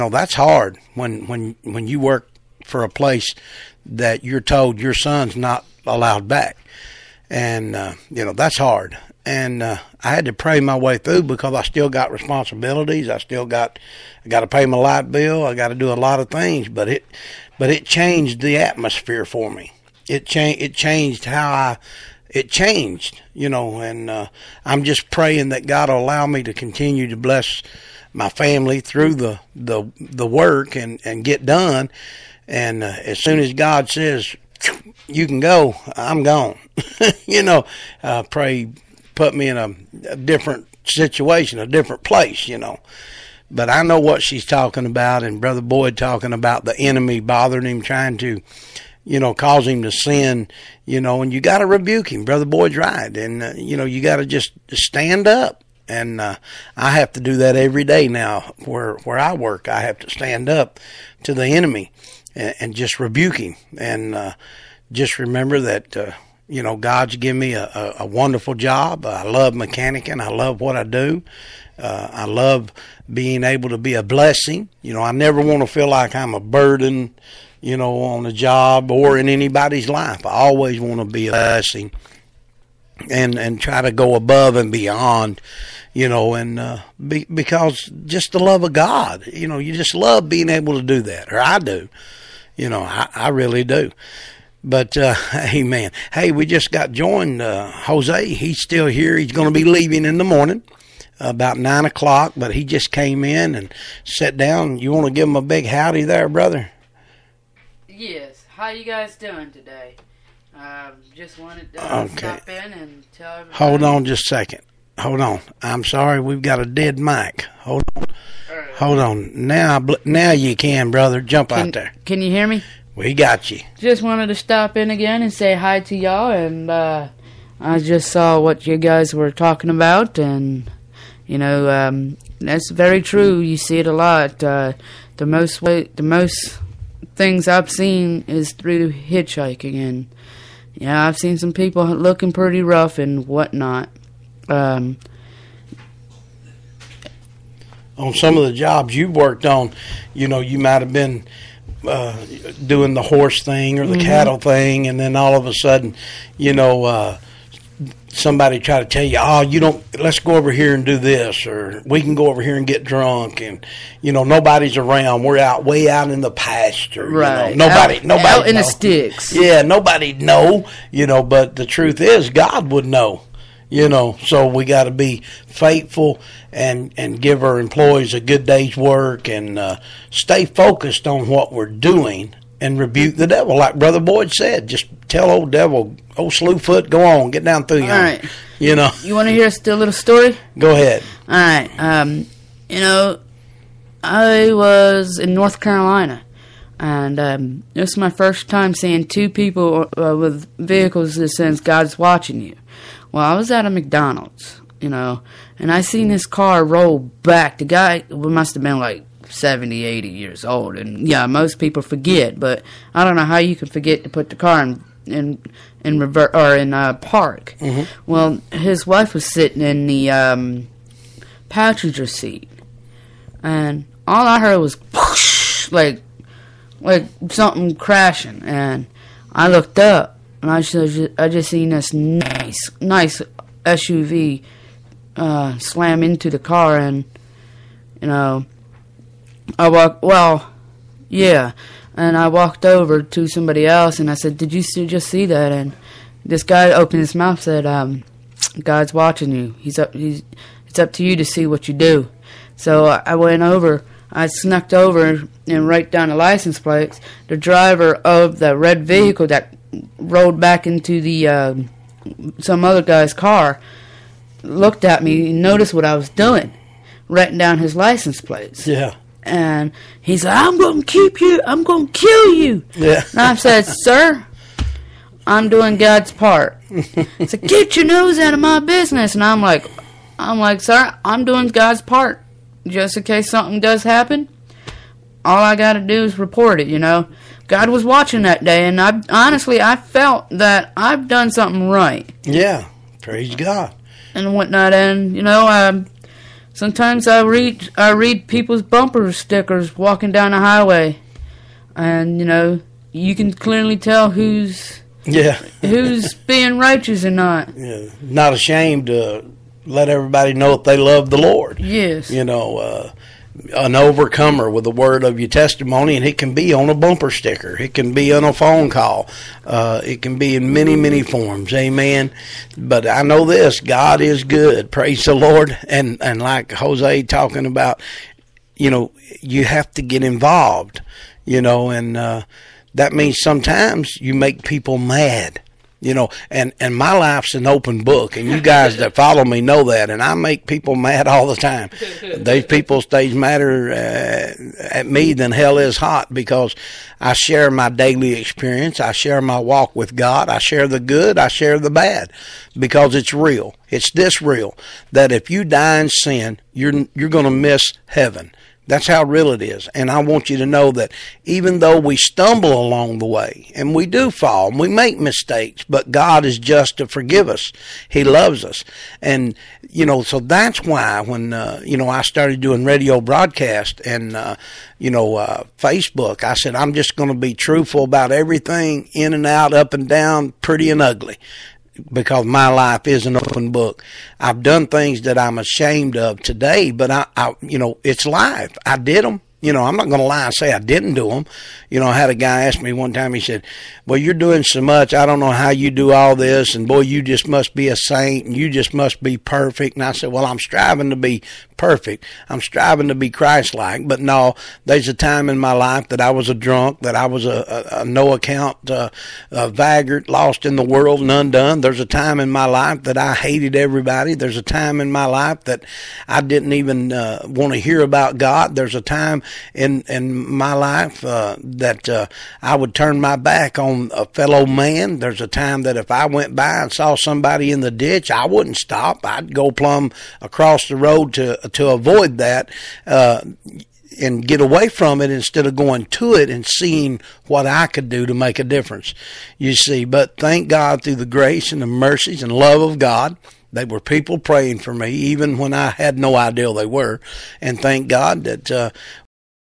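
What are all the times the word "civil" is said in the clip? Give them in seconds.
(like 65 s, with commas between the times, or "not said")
not said.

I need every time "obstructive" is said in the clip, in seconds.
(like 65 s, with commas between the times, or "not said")
not said.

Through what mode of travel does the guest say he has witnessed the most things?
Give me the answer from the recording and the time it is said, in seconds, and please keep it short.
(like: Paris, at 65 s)
Hitchhiking, at 138 s.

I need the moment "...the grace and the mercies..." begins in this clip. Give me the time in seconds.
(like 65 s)
440 s.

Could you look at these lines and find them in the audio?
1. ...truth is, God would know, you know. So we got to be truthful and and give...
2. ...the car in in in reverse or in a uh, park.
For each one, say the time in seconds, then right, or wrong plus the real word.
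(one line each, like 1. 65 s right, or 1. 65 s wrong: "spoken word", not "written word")
1. 171 s wrong: "faithful", not "truthful"
2. 214 s right.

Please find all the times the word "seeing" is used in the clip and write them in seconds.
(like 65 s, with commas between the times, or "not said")
198 s, 436 s.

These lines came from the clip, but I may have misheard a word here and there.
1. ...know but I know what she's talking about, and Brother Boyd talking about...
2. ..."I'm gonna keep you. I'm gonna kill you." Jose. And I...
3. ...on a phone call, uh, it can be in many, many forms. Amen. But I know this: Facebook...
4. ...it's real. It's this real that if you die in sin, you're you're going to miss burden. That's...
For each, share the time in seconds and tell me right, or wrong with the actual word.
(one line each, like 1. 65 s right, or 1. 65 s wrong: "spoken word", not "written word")
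1. 42 s right
2. 270 s wrong: "Yeah", not "Jose"
3. 318 s wrong: "God", not "Facebook"
4. 352 s wrong: "heaven", not "burden".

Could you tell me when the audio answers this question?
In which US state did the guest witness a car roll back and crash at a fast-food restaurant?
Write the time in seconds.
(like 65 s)
195 s.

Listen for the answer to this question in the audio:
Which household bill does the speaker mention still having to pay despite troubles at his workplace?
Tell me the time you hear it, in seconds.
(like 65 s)
14 s.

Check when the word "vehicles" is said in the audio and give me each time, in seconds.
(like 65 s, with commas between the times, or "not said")
200 s, 258 s.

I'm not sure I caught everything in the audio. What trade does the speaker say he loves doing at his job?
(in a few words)
Mechanicing.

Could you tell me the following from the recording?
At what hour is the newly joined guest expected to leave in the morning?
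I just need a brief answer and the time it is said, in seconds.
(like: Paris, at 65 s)
9 o'clock, at 101 s.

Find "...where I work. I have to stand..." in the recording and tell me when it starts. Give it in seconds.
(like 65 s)
58 s.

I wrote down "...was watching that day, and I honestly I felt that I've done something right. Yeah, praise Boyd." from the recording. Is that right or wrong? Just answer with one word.
wrong.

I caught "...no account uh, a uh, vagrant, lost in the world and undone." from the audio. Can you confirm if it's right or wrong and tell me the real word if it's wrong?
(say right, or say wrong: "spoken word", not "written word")
right.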